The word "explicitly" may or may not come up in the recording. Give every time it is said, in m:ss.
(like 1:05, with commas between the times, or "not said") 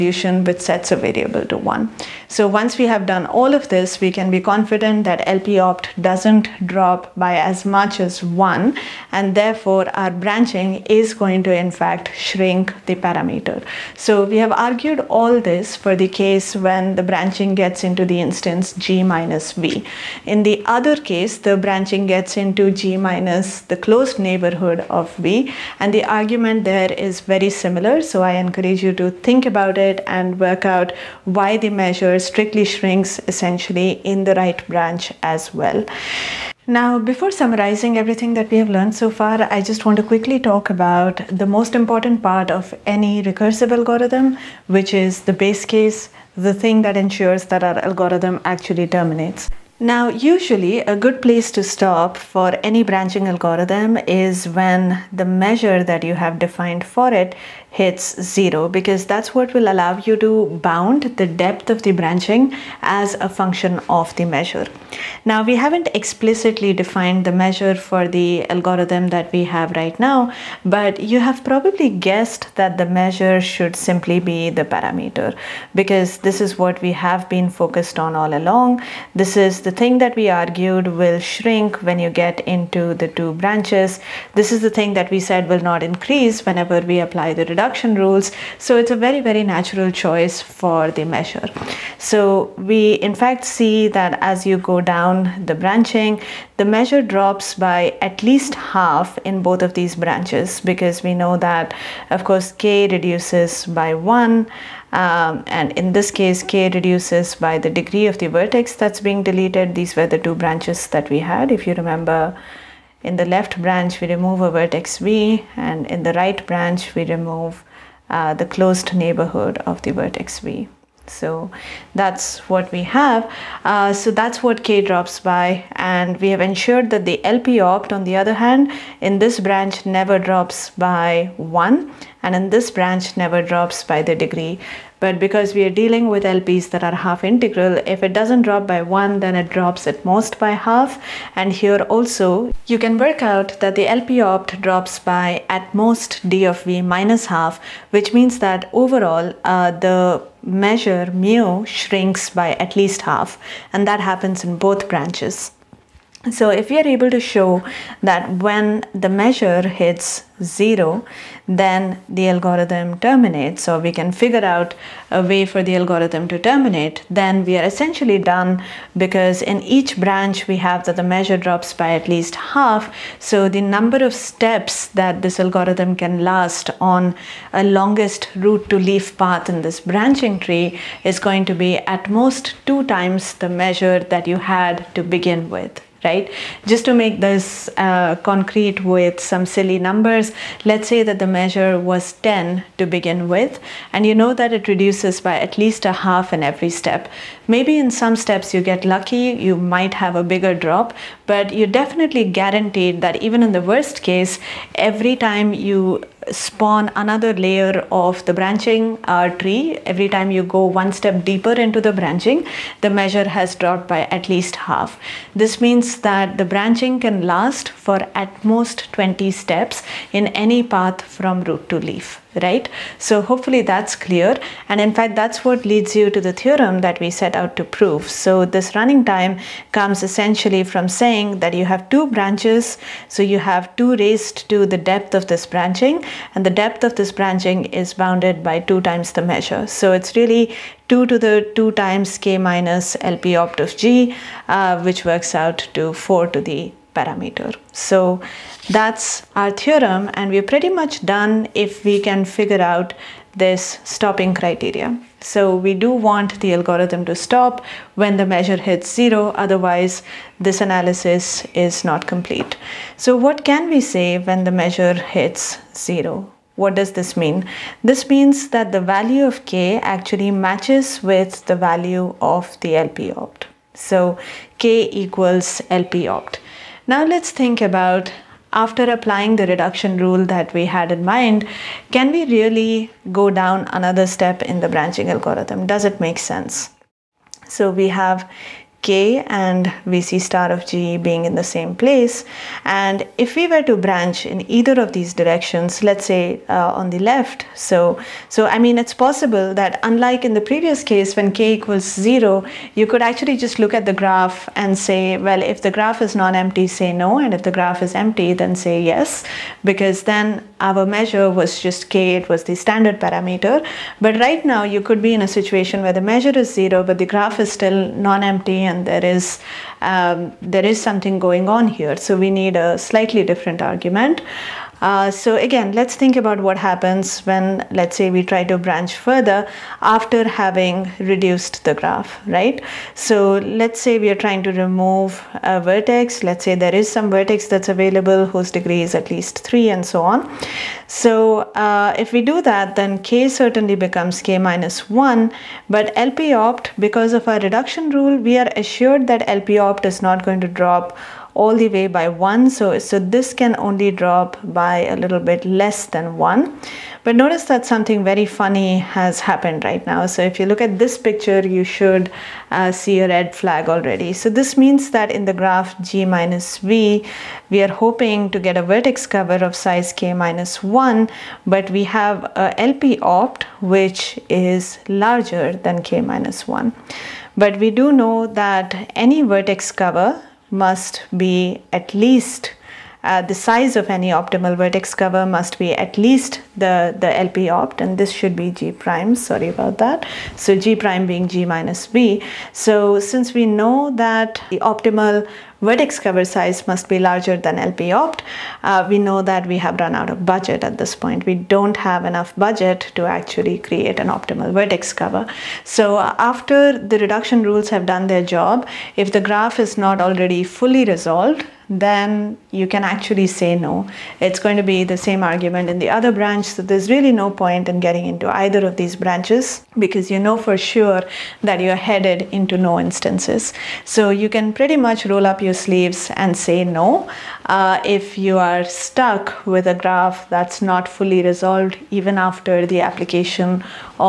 1:05.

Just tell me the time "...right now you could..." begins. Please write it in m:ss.
5:14.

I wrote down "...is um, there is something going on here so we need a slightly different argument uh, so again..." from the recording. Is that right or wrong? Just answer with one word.
right.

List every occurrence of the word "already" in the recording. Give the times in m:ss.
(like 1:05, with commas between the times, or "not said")
6:03, 6:50.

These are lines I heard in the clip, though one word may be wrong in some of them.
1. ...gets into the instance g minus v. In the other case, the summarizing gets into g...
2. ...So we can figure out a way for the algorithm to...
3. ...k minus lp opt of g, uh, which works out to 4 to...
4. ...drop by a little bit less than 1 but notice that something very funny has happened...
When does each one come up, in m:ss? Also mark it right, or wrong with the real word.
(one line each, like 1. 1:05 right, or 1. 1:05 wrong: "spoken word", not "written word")
1. 0:17 wrong: "branching", not "summarizing"
2. 2:43 right
3. 4:02 right
4. 5:54 right.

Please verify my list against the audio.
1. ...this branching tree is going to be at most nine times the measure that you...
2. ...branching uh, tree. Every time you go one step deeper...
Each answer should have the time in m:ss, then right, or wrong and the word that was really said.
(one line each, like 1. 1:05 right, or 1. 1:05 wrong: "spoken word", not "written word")
1. 2:59 wrong: "two", not "nine"
2. 3:28 right.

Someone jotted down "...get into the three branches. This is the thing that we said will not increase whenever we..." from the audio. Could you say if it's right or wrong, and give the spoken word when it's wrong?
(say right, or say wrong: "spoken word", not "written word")
wrong: "two", not "three".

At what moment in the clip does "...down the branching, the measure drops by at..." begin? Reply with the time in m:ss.
1:34.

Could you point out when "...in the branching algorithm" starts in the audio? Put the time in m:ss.
4:44.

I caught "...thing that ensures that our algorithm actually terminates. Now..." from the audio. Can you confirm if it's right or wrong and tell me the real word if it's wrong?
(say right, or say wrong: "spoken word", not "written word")
right.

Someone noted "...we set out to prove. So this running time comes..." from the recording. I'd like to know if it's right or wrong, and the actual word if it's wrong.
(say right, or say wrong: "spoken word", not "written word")
right.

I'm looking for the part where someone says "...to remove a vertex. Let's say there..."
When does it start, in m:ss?
5:34.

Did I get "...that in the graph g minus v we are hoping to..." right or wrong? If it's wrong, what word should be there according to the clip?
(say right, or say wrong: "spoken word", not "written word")
right.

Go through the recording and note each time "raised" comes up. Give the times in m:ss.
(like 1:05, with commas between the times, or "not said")
3:53.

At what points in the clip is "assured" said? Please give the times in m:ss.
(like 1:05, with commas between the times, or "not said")
5:48.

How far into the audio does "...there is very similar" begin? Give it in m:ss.
0:26.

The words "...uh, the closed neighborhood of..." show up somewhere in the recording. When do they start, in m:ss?
1:58.